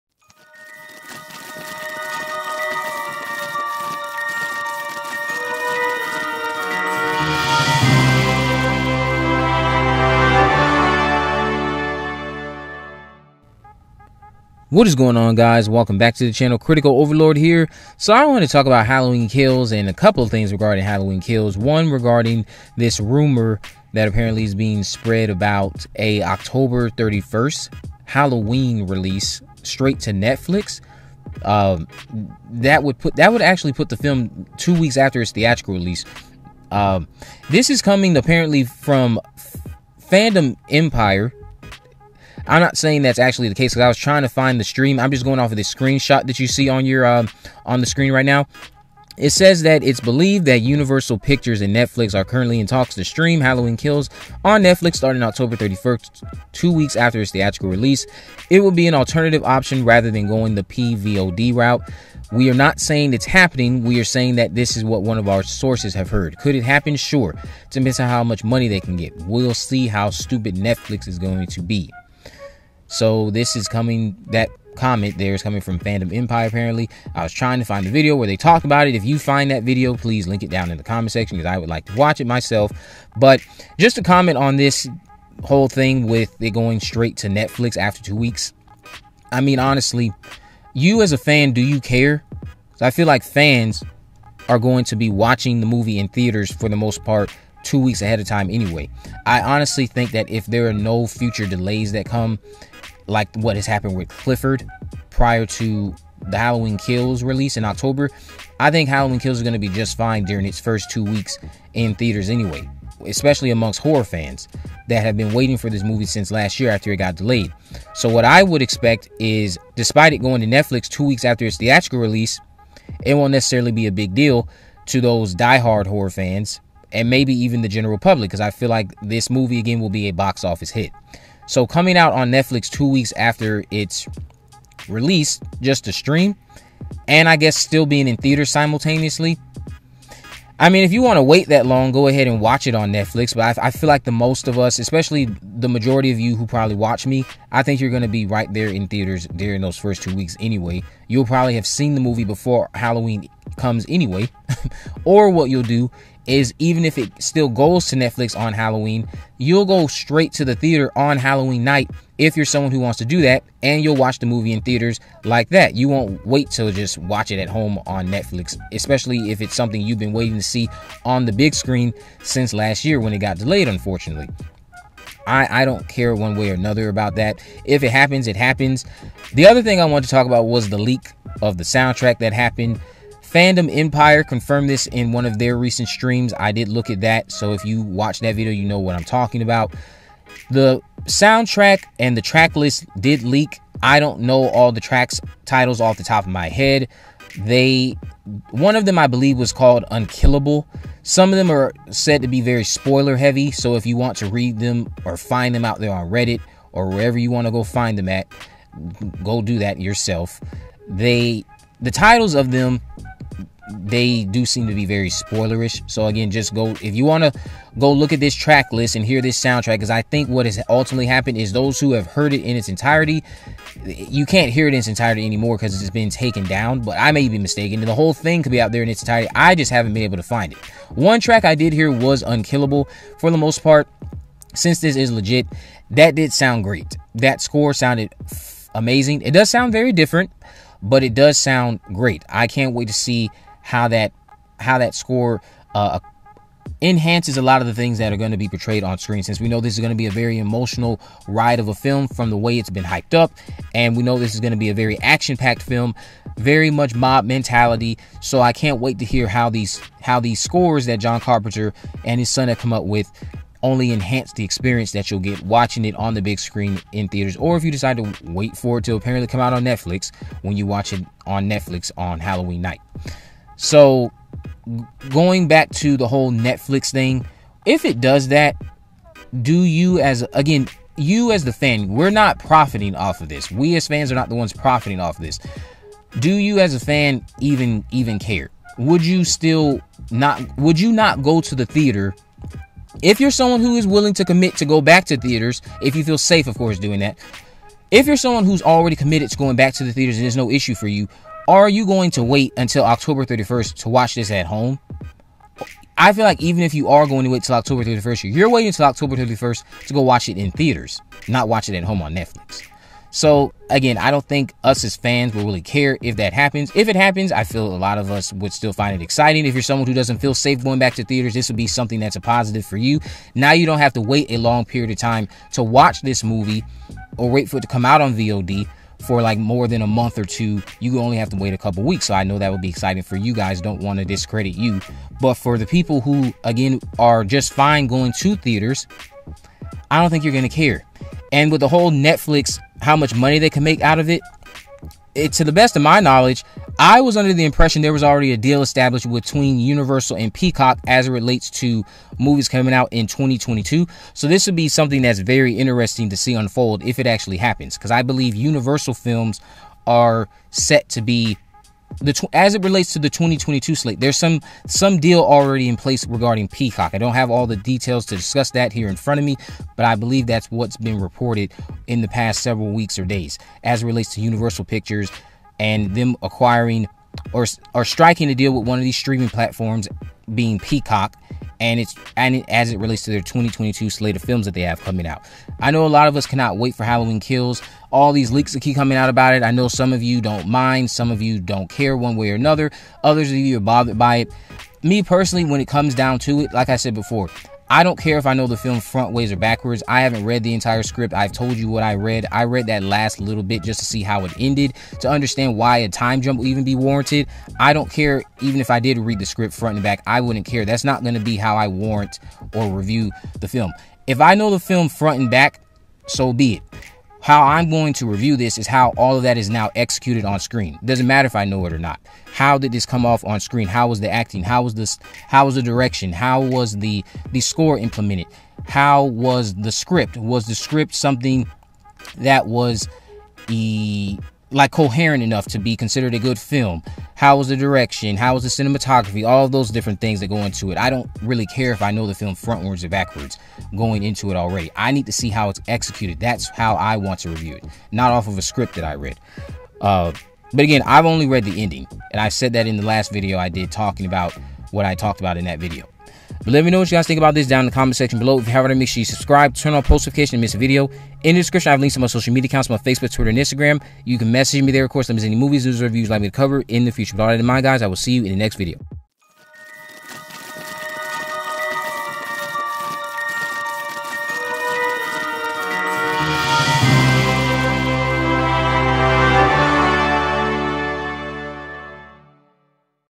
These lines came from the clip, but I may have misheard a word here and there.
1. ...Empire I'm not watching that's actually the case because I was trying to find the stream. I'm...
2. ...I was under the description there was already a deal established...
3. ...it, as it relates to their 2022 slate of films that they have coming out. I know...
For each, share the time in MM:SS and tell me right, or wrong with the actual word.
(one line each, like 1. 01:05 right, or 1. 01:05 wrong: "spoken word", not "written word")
1. 00:40 wrong: "saying", not "watching"
2. 05:46 wrong: "impression", not "description"
3. 06:22 right.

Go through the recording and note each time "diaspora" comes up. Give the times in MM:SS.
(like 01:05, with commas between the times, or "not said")
not said.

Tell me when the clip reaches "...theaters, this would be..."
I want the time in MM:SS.
05:21.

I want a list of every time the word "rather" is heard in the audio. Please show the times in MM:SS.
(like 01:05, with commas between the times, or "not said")
00:59.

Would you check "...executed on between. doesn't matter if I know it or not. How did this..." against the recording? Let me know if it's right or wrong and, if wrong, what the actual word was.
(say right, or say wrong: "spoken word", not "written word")
wrong: "screen", not "between".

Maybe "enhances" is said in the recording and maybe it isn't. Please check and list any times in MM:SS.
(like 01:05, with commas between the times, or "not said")
04:06, 04:23.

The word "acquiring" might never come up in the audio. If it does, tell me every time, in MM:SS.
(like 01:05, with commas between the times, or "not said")
06:16.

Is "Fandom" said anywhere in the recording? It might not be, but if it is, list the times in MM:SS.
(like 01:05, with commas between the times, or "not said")
00:40, 01:15, 03:03.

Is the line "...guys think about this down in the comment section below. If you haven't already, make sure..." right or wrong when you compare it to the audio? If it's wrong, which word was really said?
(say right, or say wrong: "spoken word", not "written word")
right.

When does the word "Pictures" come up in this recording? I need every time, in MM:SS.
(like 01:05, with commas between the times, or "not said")
00:51, 06:14.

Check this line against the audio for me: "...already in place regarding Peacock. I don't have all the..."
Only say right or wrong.
right.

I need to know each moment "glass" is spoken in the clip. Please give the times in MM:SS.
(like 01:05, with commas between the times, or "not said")
not said.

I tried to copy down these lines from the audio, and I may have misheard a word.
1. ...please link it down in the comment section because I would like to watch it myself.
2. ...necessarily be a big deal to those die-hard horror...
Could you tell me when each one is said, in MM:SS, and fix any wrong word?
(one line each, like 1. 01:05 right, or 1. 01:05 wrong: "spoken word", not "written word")
1. 01:19 right
2. 02:03 right.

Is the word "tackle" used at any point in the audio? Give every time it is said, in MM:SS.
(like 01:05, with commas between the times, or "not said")
not said.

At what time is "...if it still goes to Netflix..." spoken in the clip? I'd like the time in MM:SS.
02:36.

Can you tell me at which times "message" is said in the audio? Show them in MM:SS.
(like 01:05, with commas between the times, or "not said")
07:44.